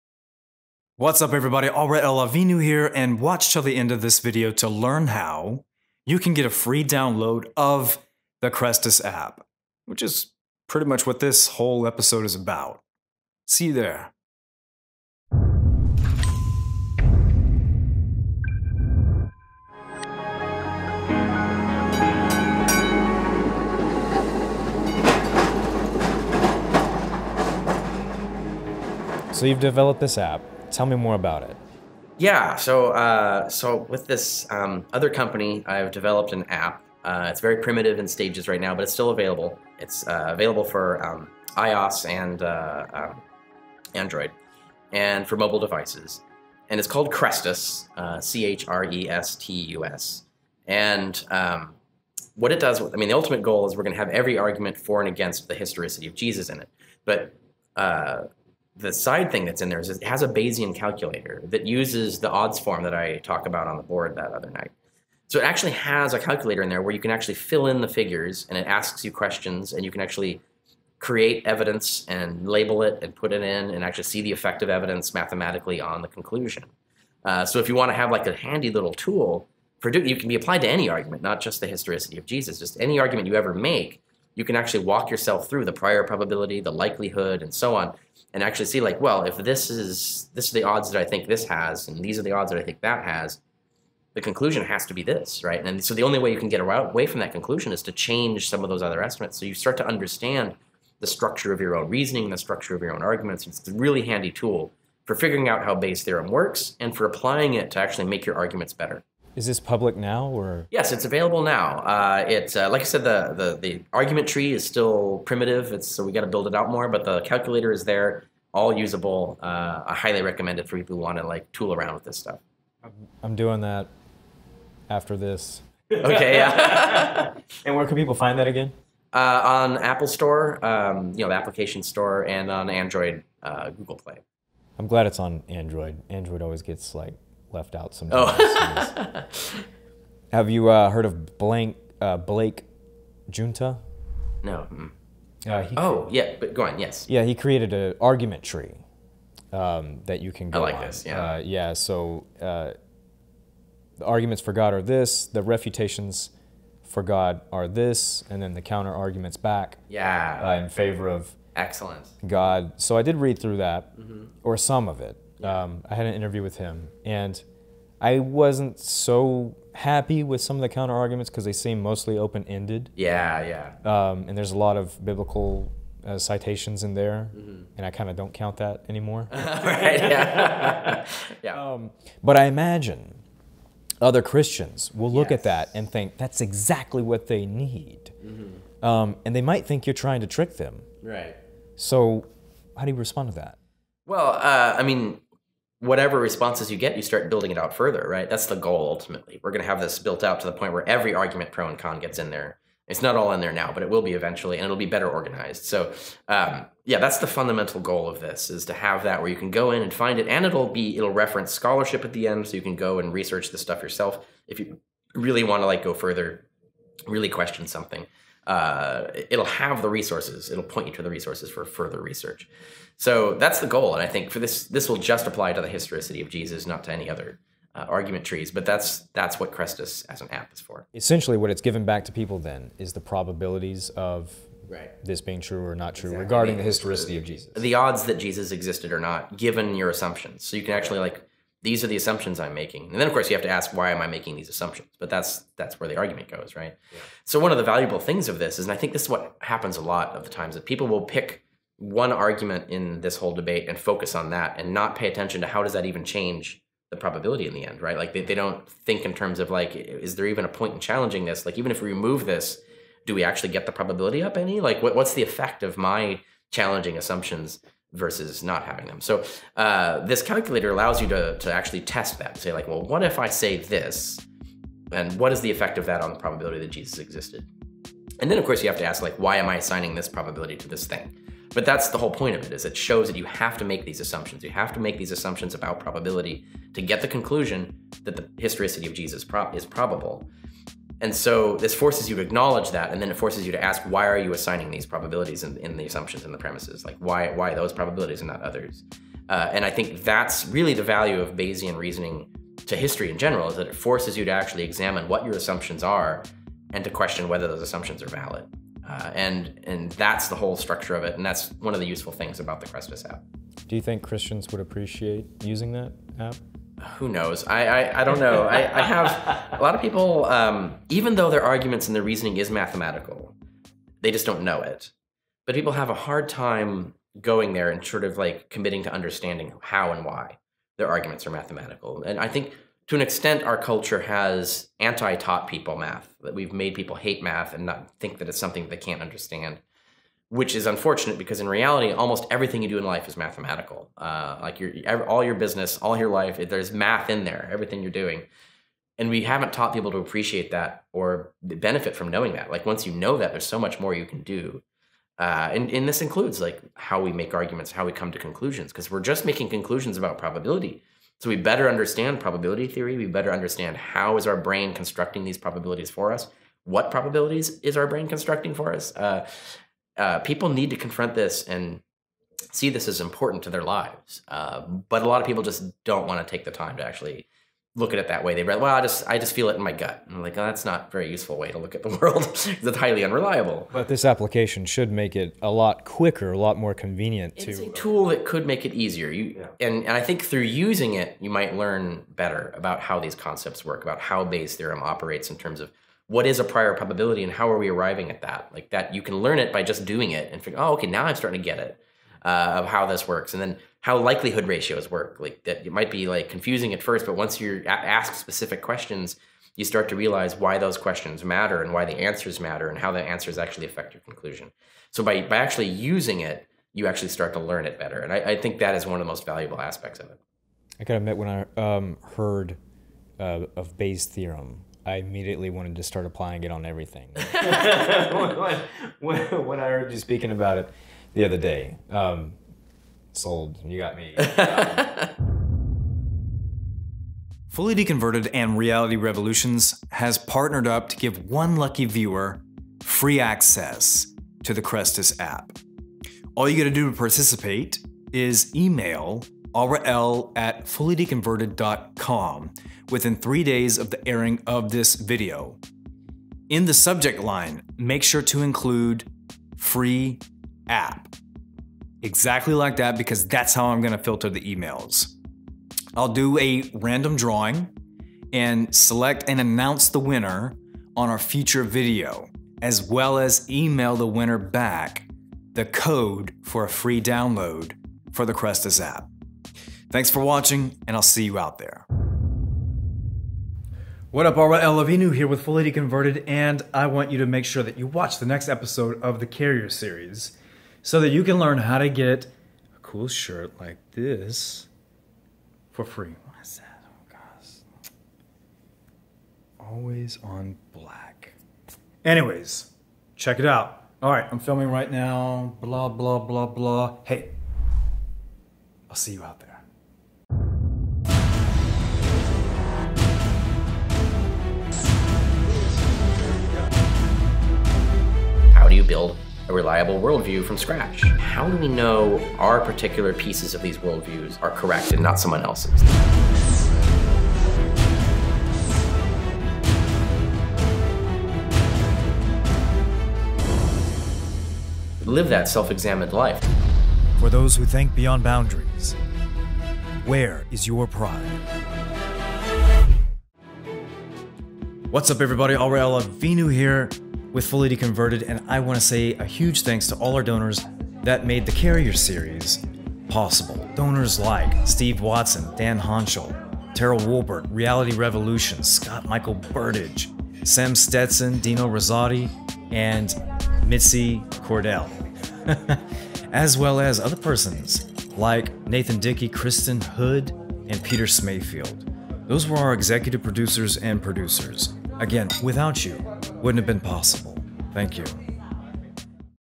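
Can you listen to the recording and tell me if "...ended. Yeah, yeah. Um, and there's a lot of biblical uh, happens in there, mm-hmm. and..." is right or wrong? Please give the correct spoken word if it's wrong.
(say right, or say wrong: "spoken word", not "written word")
wrong: "citations", not "happens".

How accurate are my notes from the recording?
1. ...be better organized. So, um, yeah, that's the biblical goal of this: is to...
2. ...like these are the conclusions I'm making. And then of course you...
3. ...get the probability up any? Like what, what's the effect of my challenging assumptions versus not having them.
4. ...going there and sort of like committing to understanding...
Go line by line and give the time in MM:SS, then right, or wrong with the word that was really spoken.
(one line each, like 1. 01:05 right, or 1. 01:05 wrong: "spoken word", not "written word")
1. 03:24 wrong: "fundamental", not "biblical"
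2. 04:00 wrong: "assumptions", not "conclusions"
3. 04:23 right
4. 05:27 right.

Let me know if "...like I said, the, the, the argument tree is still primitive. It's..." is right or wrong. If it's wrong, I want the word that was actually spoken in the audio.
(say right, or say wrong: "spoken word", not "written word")
right.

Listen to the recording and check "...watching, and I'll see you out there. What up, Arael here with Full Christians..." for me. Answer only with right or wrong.
wrong.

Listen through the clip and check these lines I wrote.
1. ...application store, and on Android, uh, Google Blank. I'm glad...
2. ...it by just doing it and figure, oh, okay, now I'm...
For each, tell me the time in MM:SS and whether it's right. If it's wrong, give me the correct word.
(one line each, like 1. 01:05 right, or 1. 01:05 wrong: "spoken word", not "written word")
1. 02:11 wrong: "Play", not "Blank"
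2. 06:39 right.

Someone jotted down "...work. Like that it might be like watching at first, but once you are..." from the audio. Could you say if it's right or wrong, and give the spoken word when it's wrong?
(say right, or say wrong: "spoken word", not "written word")
wrong: "confusing", not "watching".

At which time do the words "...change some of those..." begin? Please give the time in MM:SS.
01:37.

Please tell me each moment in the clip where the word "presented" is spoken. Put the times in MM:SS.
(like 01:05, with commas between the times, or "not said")
not said.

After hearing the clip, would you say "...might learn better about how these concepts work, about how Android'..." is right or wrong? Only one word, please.
wrong.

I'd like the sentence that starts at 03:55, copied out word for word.
this being true or not true exactly.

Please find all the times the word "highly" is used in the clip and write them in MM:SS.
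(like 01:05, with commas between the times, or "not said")
01:59, 06:22.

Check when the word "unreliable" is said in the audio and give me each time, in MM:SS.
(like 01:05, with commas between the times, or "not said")
06:23.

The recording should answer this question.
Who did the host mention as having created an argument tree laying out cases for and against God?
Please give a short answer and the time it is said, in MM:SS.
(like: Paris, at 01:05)
Blake Giunta, at 02:22.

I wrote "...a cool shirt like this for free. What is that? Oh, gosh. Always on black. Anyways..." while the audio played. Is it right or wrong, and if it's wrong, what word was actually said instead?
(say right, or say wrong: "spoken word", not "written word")
right.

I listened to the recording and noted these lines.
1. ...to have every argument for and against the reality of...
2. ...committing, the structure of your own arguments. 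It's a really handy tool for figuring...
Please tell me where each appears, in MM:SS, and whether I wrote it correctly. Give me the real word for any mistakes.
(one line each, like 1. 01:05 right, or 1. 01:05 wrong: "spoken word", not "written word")
1. 00:53 wrong: "historicity", not "reality"
2. 01:41 wrong: "reasoning", not "committing".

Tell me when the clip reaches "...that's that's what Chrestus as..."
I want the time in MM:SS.
03:48.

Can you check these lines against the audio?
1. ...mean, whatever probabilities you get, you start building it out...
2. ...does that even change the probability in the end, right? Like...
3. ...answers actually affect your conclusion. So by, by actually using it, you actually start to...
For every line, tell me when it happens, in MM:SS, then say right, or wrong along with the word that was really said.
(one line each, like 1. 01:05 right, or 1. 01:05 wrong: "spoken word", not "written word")
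1. 03:14 wrong: "responses", not "probabilities"
2. 04:15 right
3. 06:53 right.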